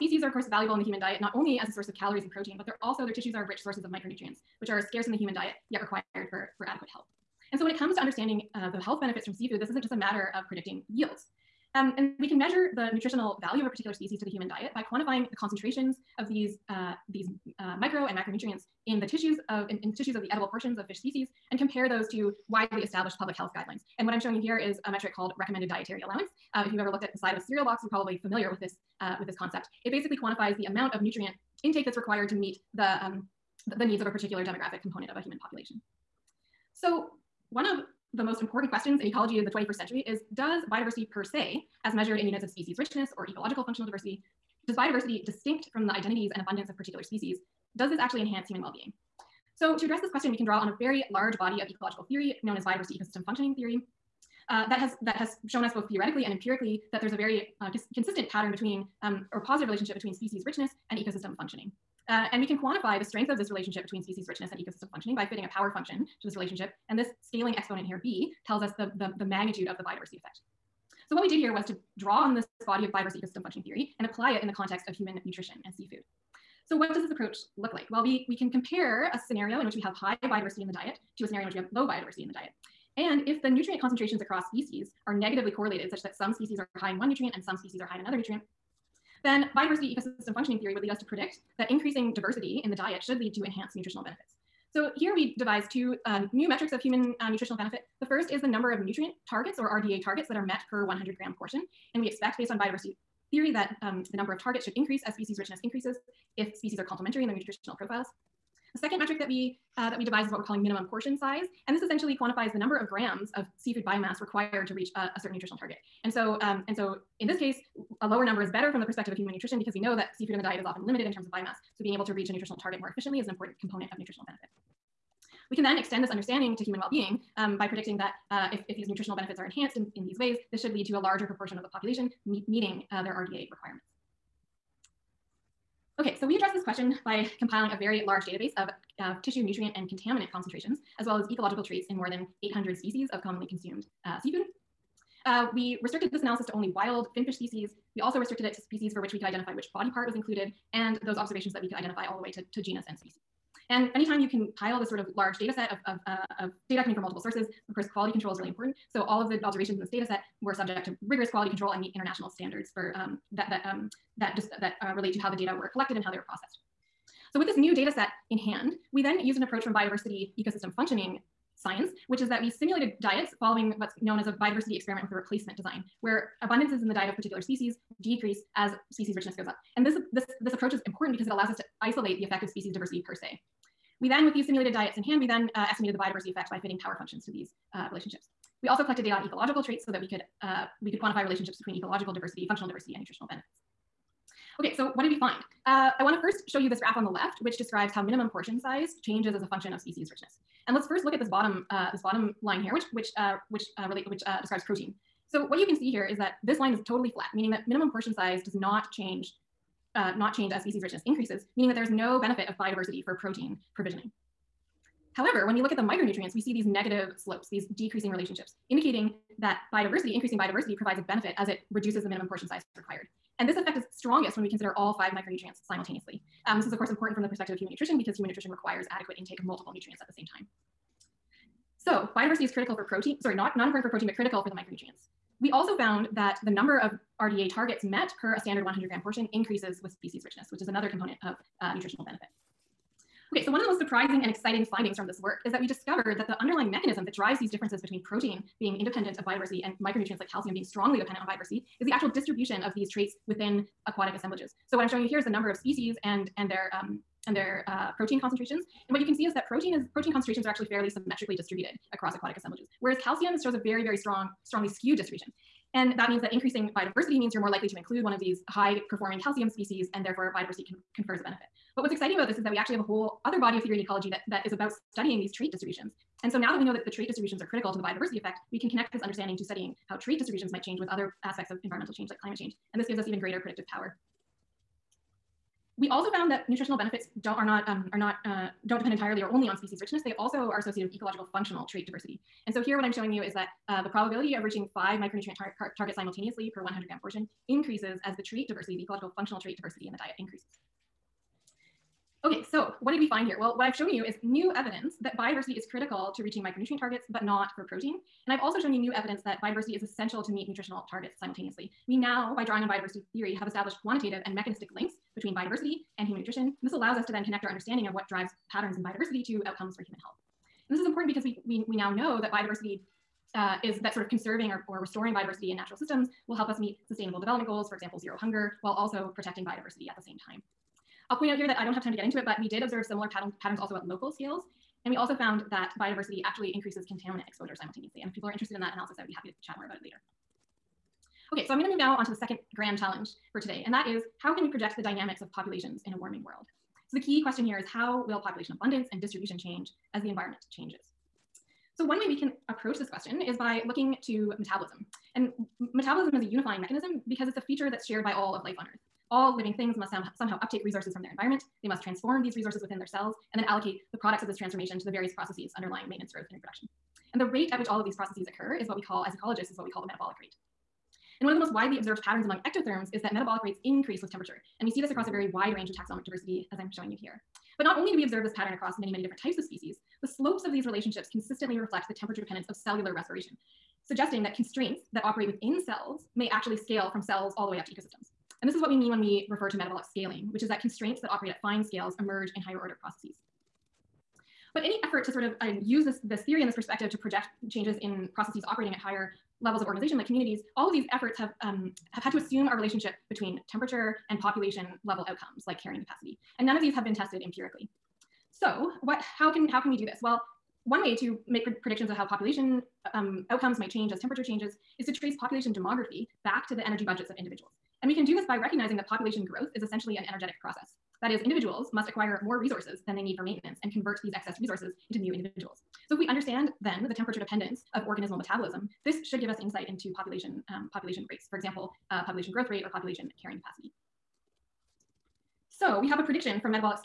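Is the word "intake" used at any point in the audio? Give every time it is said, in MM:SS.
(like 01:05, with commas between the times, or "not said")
00:31, 03:49.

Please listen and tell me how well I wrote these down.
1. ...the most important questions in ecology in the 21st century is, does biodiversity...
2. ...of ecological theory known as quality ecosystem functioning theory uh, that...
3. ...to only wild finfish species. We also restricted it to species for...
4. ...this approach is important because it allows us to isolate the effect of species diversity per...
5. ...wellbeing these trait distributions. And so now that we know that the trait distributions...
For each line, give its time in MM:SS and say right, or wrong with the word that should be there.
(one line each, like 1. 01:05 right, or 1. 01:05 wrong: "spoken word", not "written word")
1. 00:38 right
2. 00:51 wrong: "biodiversity", not "quality"
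3. 02:26 right
4. 03:00 right
5. 04:34 wrong: "studying", not "wellbeing".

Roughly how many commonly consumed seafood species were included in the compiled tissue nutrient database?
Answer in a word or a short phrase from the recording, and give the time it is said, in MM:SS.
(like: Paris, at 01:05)
more than 800, at 02:21.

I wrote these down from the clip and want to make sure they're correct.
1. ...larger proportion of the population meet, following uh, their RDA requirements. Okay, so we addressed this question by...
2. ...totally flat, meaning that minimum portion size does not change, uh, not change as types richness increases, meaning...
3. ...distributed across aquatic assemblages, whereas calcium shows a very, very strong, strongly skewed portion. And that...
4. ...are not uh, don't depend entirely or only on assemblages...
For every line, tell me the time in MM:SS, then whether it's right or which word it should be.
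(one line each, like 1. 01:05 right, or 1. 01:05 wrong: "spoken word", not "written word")
1. 02:10 wrong: "meeting", not "following"
2. 03:26 wrong: "species", not "types"
3. 04:21 wrong: "distribution", not "portion"
4. 04:47 wrong: "species", not "assemblages".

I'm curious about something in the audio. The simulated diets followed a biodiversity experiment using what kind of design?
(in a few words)
replacement design.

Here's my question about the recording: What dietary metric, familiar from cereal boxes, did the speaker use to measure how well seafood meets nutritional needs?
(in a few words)
recommended dietary allowance.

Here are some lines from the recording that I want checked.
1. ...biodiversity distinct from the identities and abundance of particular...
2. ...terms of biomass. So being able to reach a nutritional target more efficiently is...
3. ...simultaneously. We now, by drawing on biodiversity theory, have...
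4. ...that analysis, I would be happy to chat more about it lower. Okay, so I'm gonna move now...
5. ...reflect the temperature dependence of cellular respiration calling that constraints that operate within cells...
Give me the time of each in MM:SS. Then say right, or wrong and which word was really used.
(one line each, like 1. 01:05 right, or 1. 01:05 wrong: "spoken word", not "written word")
1. 00:44 right
2. 02:01 right
3. 05:11 right
4. 05:38 wrong: "later", not "lower"
5. 06:21 wrong: "suggesting", not "calling".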